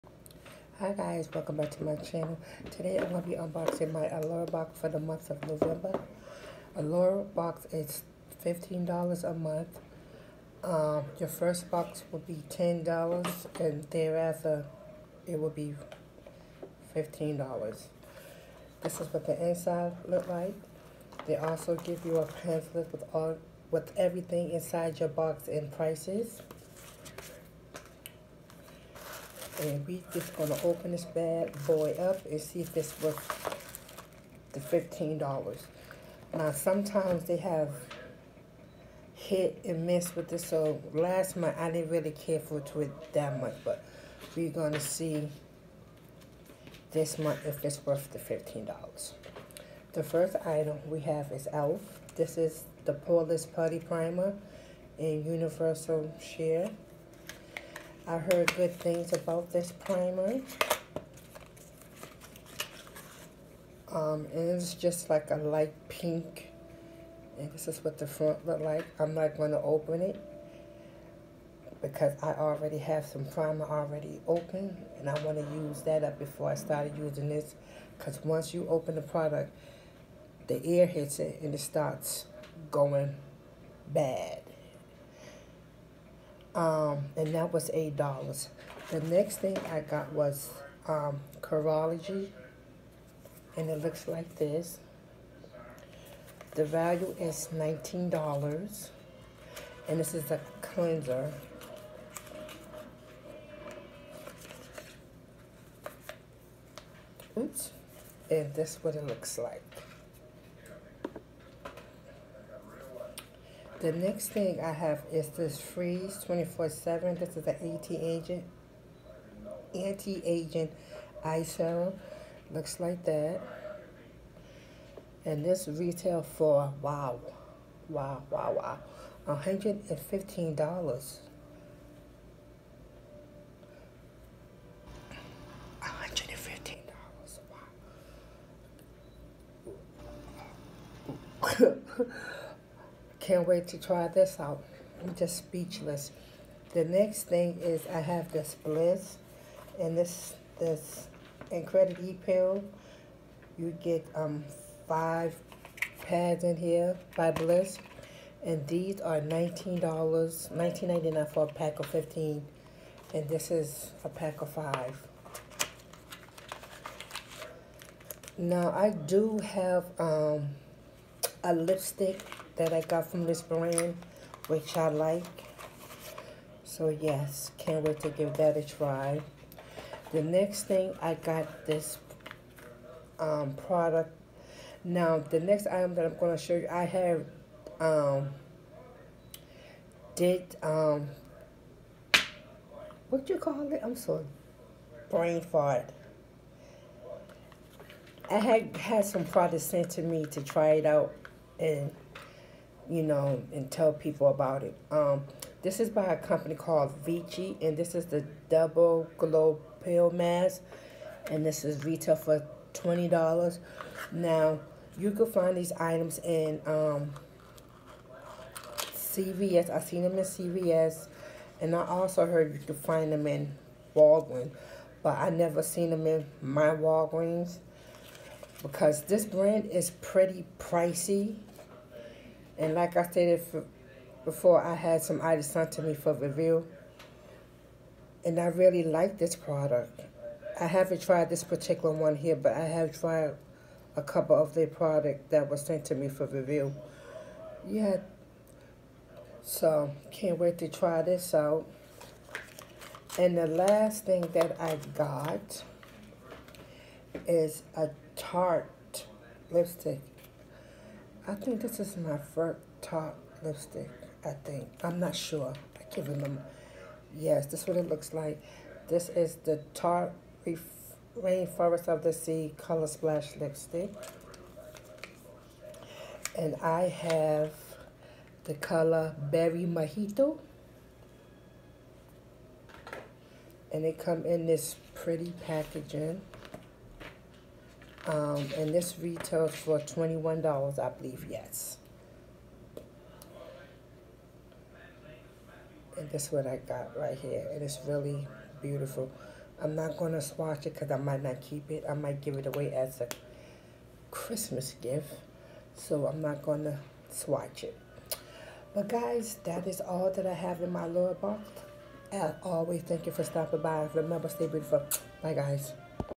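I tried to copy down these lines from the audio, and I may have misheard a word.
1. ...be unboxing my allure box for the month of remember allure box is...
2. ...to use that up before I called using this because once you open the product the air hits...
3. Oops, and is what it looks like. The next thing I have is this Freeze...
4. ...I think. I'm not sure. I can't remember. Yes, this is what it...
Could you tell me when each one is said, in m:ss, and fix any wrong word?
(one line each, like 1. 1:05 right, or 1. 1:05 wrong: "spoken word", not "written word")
1. 0:03 wrong: "november", not "remember"
2. 1:15 wrong: "started", not "called"
3. 1:47 right
4. 4:24 right.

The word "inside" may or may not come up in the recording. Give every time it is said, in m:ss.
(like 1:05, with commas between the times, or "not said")
0:19, 0:24.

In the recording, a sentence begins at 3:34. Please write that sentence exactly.
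Now, you can find these items in um, CVS.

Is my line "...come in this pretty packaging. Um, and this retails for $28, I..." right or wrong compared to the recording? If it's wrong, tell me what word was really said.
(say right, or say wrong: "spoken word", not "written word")
wrong: "21", not "28".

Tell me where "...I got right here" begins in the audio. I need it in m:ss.
4:56.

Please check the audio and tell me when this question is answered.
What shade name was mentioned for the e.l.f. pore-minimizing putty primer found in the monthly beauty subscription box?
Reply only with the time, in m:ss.
0:55.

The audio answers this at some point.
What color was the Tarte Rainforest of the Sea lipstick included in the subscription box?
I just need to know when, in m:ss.
4:39.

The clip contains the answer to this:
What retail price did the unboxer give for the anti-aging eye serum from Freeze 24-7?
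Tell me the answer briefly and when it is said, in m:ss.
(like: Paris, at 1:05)
$115, at 2:09.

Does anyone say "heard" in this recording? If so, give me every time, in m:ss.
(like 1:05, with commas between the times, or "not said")
0:58, 3:42.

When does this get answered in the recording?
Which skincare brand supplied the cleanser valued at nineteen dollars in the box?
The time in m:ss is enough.
1:31.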